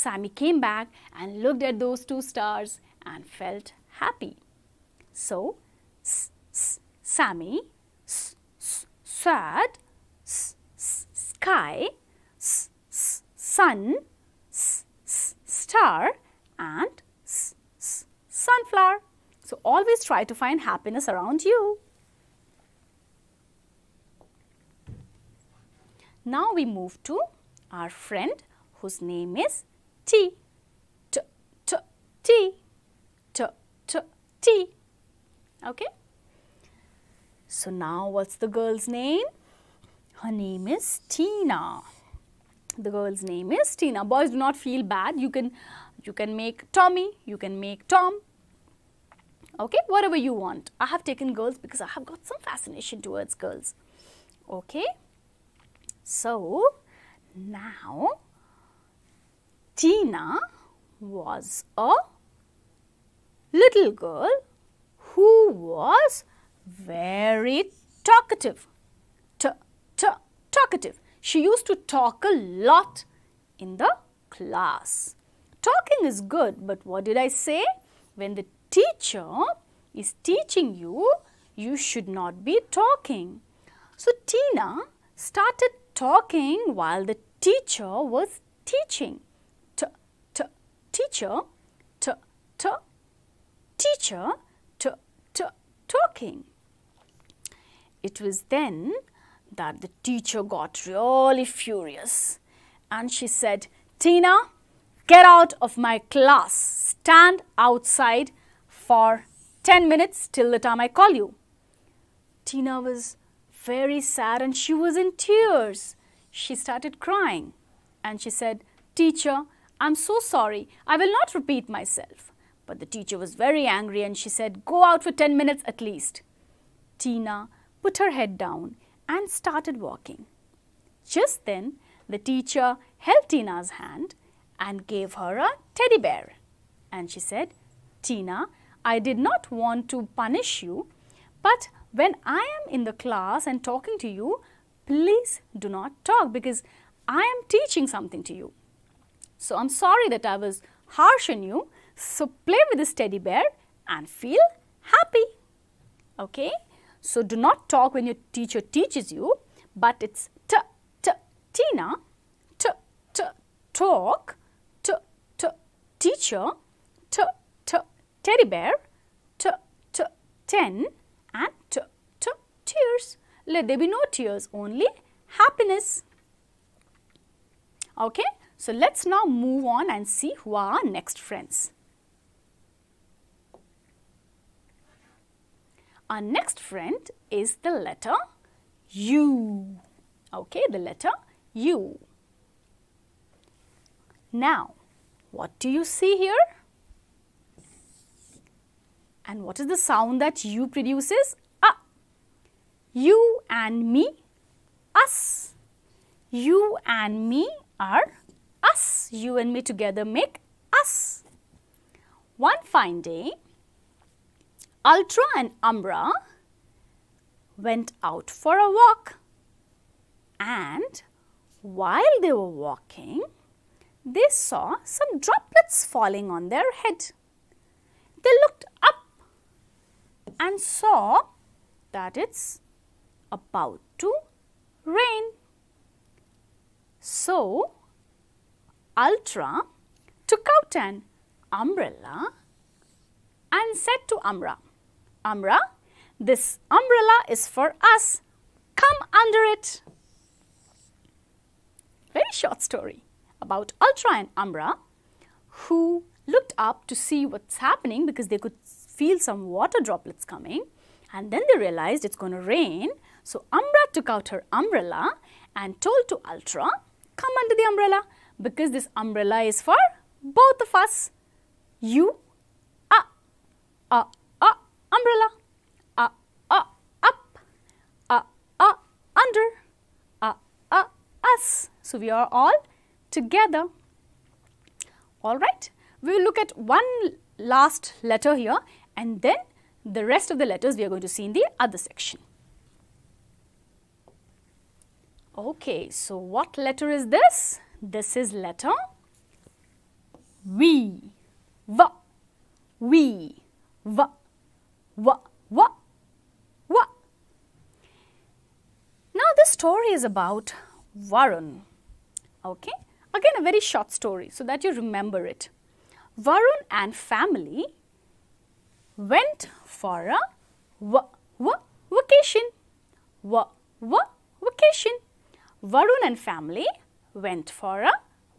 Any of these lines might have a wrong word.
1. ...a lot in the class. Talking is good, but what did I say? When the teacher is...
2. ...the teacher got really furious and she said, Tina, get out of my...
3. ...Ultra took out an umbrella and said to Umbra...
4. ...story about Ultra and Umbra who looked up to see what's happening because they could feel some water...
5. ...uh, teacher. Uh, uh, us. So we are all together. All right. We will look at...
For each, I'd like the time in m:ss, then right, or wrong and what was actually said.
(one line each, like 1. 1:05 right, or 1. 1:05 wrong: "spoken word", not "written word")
1. 1:12 right
2. 1:39 right
3. 3:58 right
4. 4:12 right
5. 4:38 wrong: "under", not "teacher".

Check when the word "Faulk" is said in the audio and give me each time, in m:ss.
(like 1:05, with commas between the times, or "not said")
not said.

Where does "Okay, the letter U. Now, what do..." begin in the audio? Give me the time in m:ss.
3:10.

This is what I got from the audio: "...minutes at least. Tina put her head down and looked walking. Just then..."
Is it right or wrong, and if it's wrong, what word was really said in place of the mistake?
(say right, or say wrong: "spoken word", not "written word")
wrong: "started", not "looked".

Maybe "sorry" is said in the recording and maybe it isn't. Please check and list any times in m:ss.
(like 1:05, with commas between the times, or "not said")
2:00, 2:29.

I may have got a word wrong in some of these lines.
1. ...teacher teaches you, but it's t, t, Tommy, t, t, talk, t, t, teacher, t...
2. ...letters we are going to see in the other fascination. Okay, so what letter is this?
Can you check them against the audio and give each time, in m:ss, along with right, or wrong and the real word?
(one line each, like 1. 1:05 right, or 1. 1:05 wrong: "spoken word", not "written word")
1. 2:38 wrong: "Tina", not "Tommy"
2. 4:50 wrong: "section", not "fascination".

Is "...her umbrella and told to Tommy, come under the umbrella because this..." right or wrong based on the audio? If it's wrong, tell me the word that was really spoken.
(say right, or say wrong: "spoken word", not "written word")
wrong: "Ultra", not "Tommy".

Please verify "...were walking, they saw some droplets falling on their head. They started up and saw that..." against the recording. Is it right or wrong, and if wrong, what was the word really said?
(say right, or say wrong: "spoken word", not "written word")
wrong: "looked", not "started".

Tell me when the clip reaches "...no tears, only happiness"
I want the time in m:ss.
2:53.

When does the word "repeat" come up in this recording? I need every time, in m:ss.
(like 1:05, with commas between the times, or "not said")
2:01.